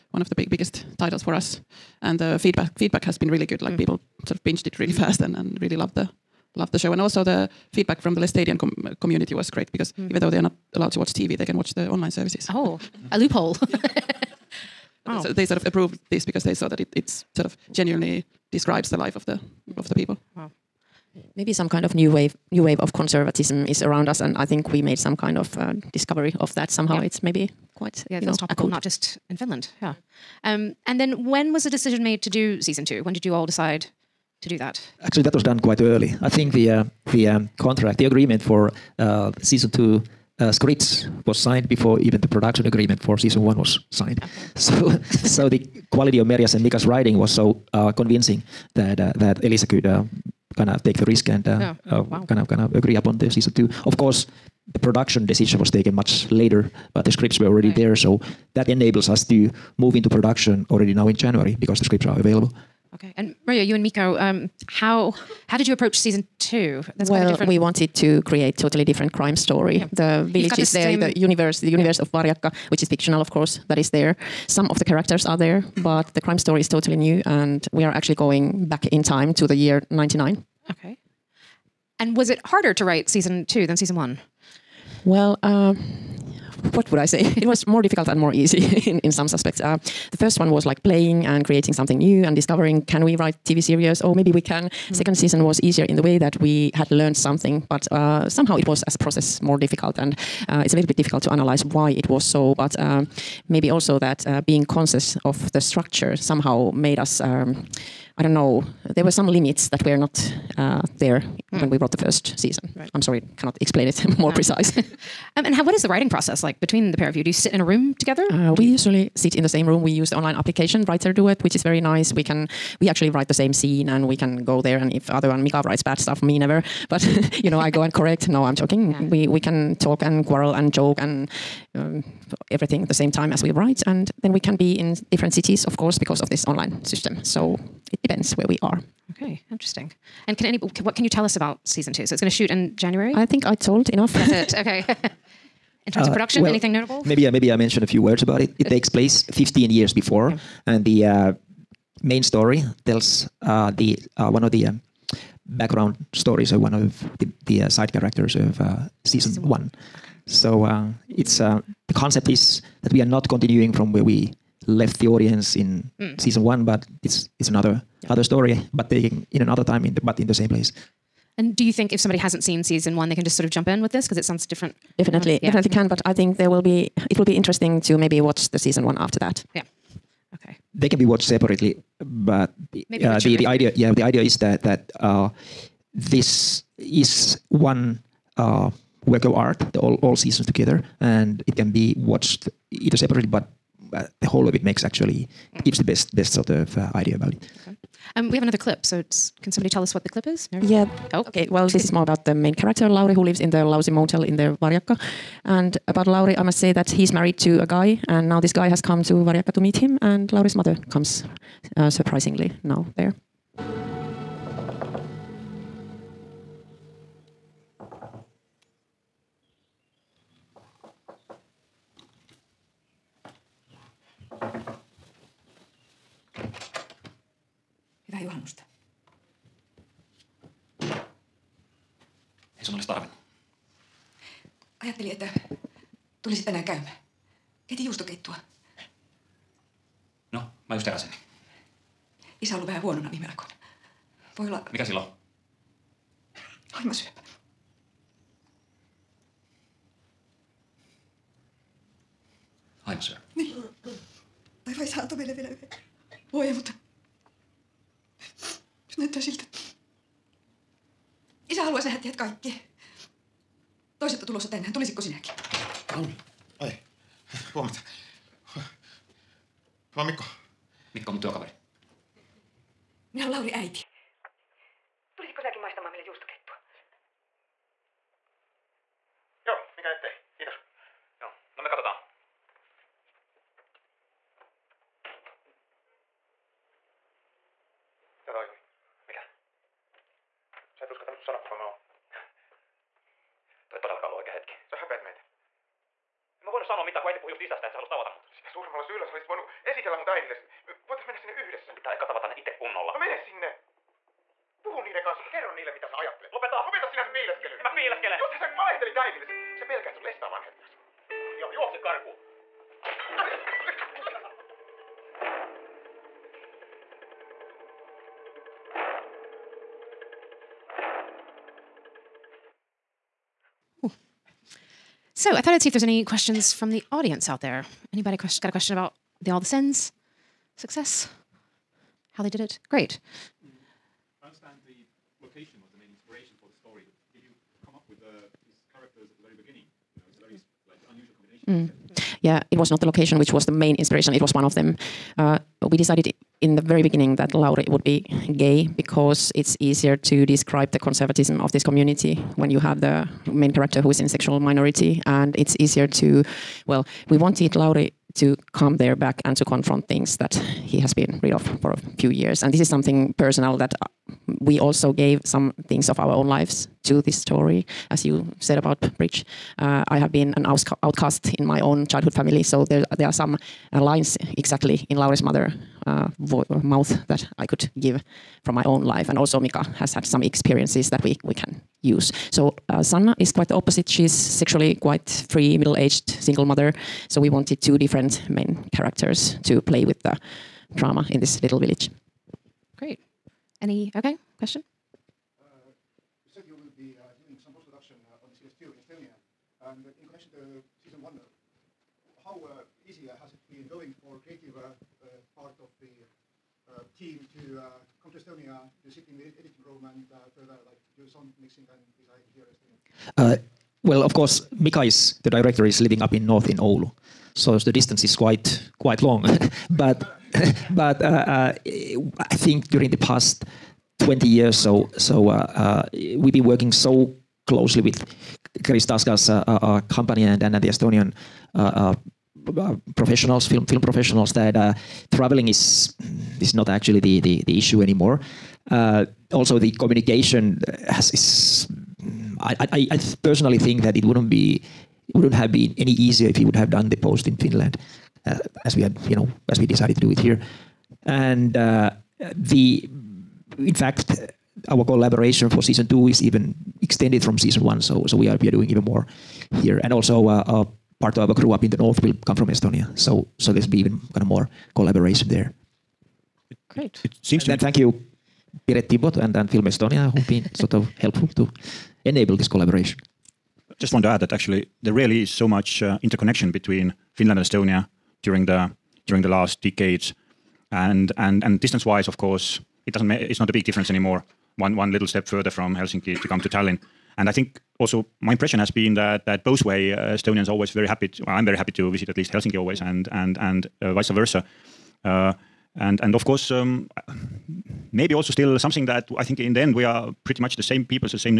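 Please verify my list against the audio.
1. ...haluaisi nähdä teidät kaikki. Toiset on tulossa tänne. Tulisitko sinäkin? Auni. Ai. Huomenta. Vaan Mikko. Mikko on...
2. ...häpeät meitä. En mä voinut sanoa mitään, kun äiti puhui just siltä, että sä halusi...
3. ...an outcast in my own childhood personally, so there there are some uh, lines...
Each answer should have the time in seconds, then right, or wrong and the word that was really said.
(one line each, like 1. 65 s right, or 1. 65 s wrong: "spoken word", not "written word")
1. 261 s right
2. 294 s wrong: "isästä", not "siltä"
3. 370 s wrong: "family", not "personally".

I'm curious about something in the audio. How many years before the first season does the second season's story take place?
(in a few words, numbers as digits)
15.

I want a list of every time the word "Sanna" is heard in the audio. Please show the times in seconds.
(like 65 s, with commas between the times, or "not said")
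382 s.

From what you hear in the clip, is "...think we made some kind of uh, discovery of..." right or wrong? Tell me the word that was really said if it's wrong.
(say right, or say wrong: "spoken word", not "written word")
right.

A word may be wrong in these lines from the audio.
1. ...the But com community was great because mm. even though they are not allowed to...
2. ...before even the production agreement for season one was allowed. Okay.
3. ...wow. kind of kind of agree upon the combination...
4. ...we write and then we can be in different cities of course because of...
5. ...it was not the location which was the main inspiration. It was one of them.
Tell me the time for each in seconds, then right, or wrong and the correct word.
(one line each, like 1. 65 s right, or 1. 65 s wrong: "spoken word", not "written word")
1. 8 s wrong: "Laestadian", not "But"
2. 41 s wrong: "signed", not "allowed"
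3. 52 s wrong: "season", not "combination"
4. 133 s right
5. 342 s right.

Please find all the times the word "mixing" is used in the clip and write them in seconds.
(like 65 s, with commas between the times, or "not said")
411 s.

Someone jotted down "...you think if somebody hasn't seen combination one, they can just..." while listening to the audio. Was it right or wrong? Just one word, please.
wrong.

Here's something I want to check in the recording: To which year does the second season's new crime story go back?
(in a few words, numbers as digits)
1999.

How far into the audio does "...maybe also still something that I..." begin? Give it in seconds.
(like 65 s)
497 s.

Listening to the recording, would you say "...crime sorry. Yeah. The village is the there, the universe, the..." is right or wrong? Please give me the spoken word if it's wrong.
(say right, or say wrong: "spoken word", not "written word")
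wrong: "story", not "sorry".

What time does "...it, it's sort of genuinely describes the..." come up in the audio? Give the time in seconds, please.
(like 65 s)
16 s.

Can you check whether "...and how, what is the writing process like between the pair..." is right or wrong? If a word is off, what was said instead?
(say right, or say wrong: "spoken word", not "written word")
right.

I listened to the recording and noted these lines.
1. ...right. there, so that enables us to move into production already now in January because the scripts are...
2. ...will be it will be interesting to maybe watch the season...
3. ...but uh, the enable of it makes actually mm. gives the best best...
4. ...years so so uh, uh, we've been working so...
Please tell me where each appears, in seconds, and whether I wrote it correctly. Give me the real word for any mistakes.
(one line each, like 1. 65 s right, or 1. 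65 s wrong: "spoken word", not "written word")
1. 57 s right
2. 176 s right
3. 193 s wrong: "whole", not "enable"
4. 424 s right.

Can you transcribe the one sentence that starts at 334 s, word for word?
I understand the location was the main inspiration for the story.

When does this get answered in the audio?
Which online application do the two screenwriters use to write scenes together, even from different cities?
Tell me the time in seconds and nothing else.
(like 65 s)
120 s.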